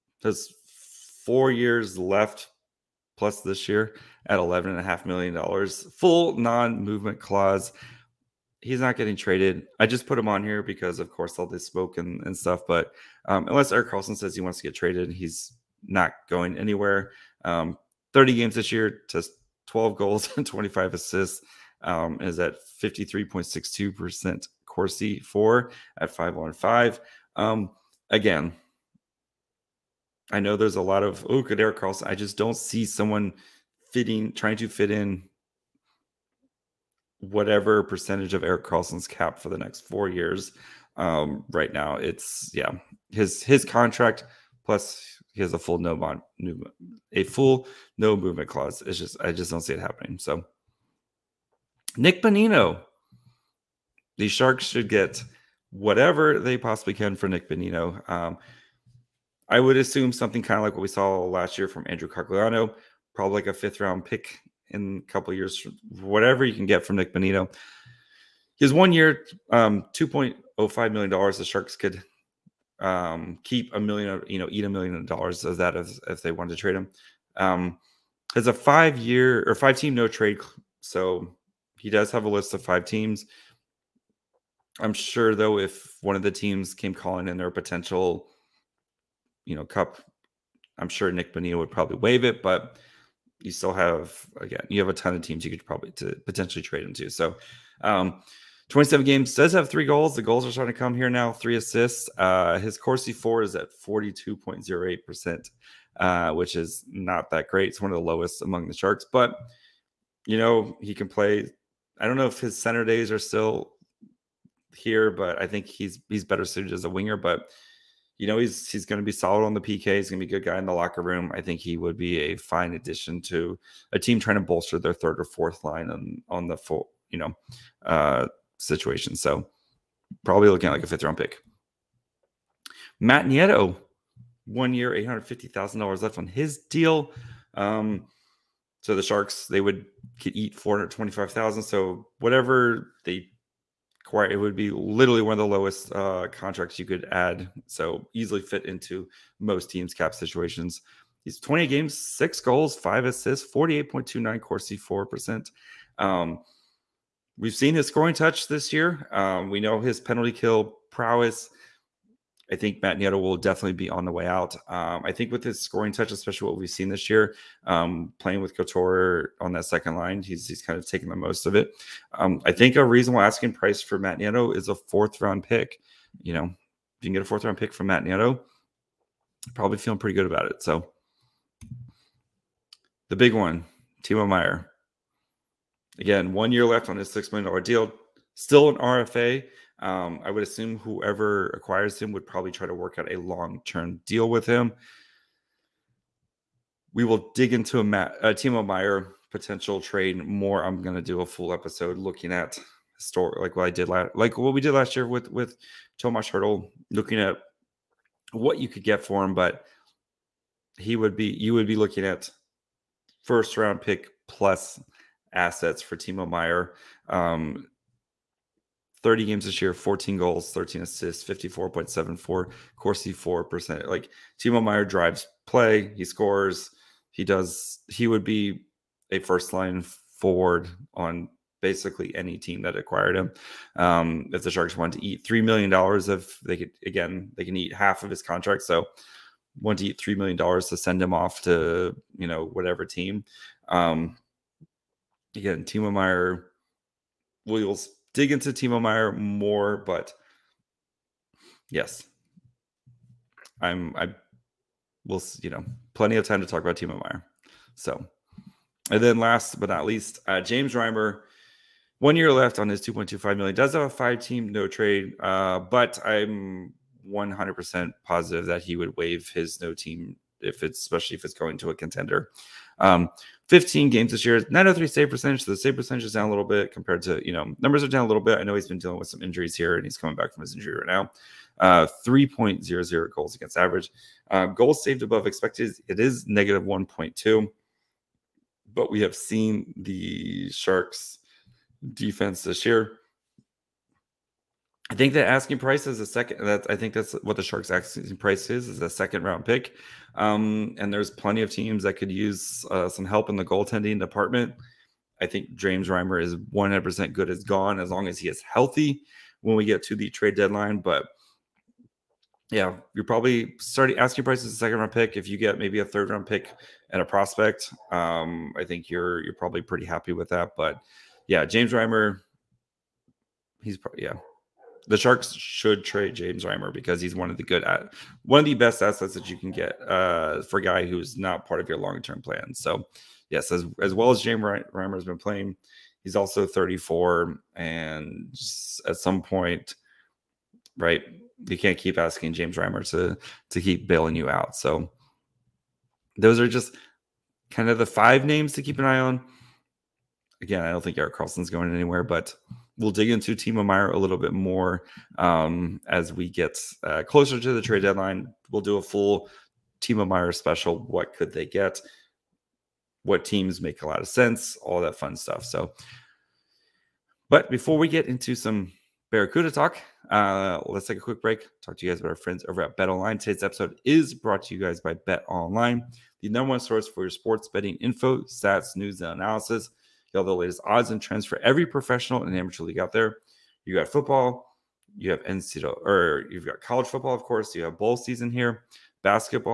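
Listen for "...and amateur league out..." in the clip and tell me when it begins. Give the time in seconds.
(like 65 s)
382 s.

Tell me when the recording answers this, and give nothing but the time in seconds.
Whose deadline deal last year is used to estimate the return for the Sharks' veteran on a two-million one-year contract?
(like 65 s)
61 s.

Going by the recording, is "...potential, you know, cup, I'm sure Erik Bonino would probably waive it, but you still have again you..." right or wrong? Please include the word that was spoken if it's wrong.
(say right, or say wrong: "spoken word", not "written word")
wrong: "Nick", not "Erik".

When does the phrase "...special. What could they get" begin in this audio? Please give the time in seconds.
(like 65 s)
360 s.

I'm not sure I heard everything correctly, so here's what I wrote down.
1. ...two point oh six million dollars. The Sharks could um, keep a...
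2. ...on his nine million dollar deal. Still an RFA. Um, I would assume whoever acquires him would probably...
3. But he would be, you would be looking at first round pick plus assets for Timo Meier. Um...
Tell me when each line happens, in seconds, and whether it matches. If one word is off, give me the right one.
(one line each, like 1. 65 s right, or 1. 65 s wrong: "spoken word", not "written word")
1. 69 s wrong: "five", not "six"
2. 186 s wrong: "six", not "nine"
3. 209 s right.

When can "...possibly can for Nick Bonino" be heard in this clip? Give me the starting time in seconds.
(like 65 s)
56 s.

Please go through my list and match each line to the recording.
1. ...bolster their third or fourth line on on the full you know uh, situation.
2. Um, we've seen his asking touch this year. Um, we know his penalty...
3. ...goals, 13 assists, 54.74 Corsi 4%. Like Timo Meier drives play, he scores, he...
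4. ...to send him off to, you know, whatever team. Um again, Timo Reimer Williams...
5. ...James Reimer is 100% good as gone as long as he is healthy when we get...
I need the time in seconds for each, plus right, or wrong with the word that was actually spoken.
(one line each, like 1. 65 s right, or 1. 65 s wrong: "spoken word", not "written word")
1. 124 s right
2. 155 s wrong: "scoring", not "asking"
3. 220 s right
4. 240 s wrong: "Meier", not "Reimer"
5. 305 s right.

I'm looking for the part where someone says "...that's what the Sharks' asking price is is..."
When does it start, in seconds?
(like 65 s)
296 s.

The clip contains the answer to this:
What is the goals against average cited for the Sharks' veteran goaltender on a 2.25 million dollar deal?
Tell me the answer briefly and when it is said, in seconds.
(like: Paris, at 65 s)
3.00, at 282 s.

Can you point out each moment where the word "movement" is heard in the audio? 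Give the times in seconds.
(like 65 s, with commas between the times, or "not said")
6 s, 48 s.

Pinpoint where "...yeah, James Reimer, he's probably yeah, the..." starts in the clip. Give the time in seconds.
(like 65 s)
321 s.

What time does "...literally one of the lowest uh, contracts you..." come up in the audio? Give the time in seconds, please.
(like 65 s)
144 s.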